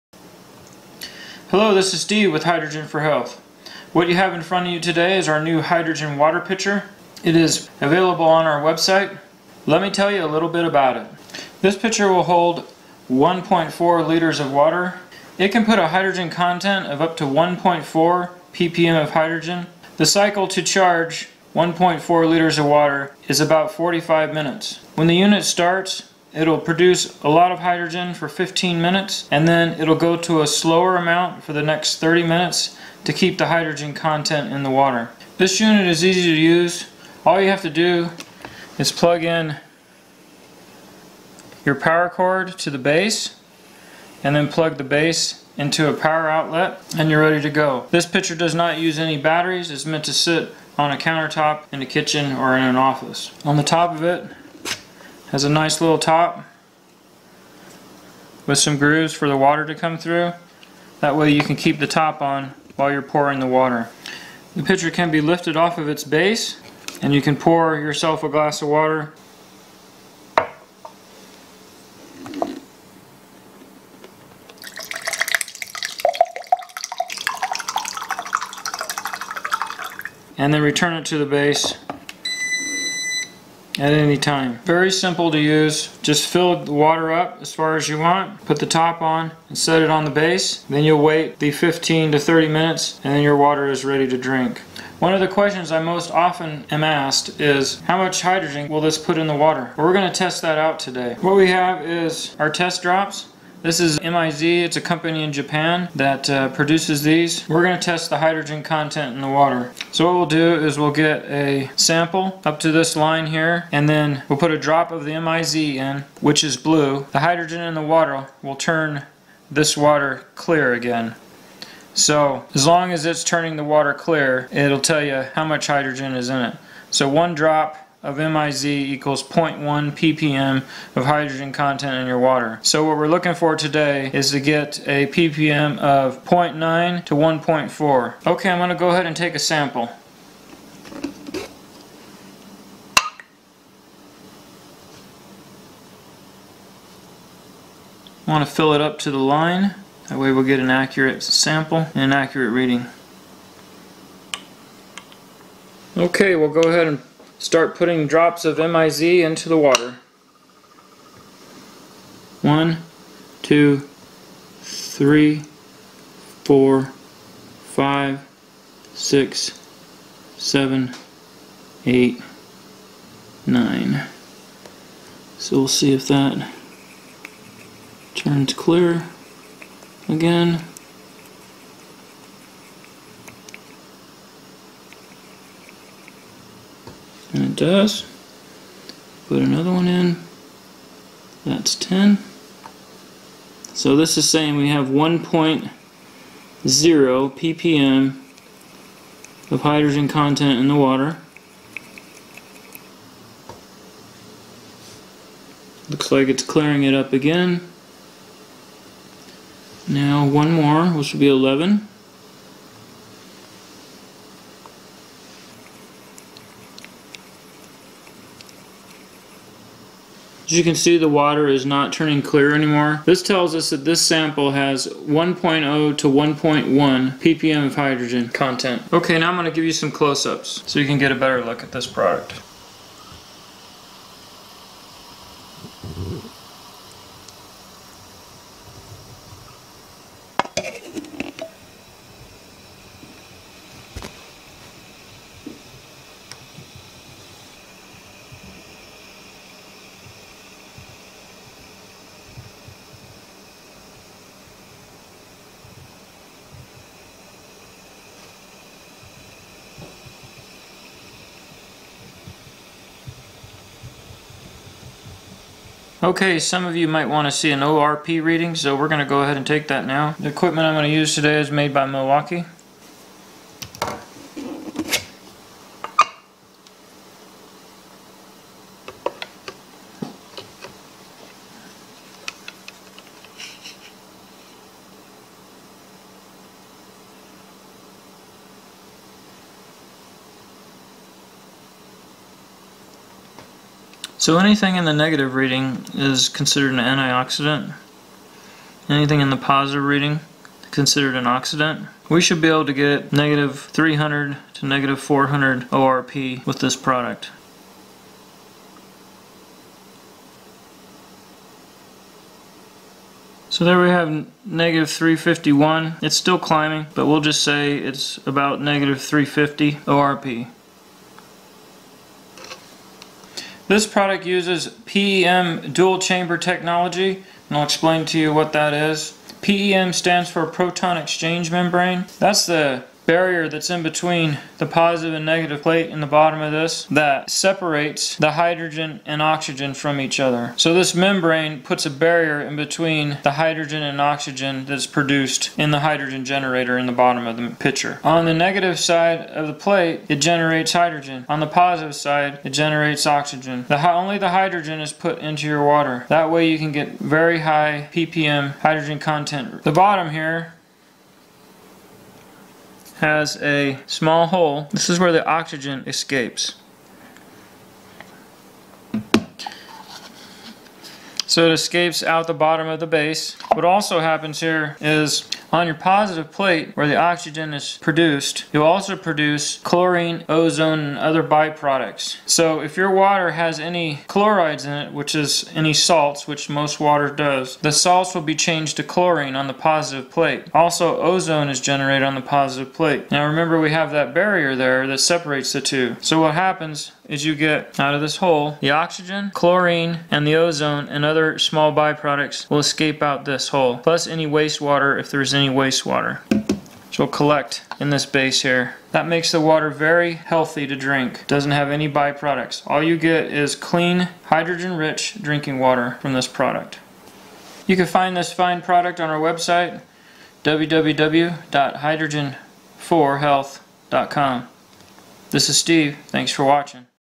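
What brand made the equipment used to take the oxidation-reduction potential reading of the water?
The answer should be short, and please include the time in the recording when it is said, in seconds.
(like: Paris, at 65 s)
Milwaukee, at 271 s.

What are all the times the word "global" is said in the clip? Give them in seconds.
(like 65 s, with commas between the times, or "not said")
not said.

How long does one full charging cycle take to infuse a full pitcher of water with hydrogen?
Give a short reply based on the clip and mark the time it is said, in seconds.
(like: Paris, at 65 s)
45 minutes, at 23 s.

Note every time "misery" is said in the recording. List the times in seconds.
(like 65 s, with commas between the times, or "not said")
not said.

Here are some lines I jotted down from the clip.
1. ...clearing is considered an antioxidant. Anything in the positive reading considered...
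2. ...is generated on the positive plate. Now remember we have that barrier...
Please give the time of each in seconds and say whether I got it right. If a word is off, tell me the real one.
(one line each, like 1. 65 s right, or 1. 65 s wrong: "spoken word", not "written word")
1. 295 s wrong: "reading", not "clearing"
2. 391 s right.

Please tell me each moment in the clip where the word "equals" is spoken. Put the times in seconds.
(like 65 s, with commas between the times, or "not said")
128 s.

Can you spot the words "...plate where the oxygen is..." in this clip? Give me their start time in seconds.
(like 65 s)
376 s.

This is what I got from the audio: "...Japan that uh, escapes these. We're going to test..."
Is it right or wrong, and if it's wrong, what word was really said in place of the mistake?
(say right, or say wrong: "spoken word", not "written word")
wrong: "produces", not "escapes".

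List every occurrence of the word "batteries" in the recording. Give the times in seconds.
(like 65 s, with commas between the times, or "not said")
49 s.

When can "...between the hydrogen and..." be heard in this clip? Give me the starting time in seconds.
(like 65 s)
342 s.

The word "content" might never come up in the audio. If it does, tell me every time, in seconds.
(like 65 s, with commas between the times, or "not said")
16 s, 33 s, 108 s, 131 s, 200 s, 228 s, 358 s.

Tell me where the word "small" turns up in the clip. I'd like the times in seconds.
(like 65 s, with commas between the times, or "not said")
363 s, 401 s.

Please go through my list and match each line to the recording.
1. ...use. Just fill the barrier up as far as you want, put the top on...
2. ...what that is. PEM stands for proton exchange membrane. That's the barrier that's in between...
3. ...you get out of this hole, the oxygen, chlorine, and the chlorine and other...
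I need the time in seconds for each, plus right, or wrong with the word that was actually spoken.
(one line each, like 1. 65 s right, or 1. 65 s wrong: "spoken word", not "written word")
1. 85 s wrong: "water", not "barrier"
2. 328 s right
3. 397 s wrong: "ozone", not "chlorine".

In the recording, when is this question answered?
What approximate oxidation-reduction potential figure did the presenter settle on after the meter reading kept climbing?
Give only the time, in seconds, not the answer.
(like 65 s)
318 s.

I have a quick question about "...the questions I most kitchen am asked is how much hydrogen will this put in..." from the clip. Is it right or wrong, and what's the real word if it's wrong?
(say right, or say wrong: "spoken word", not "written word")
wrong: "often", not "kitchen".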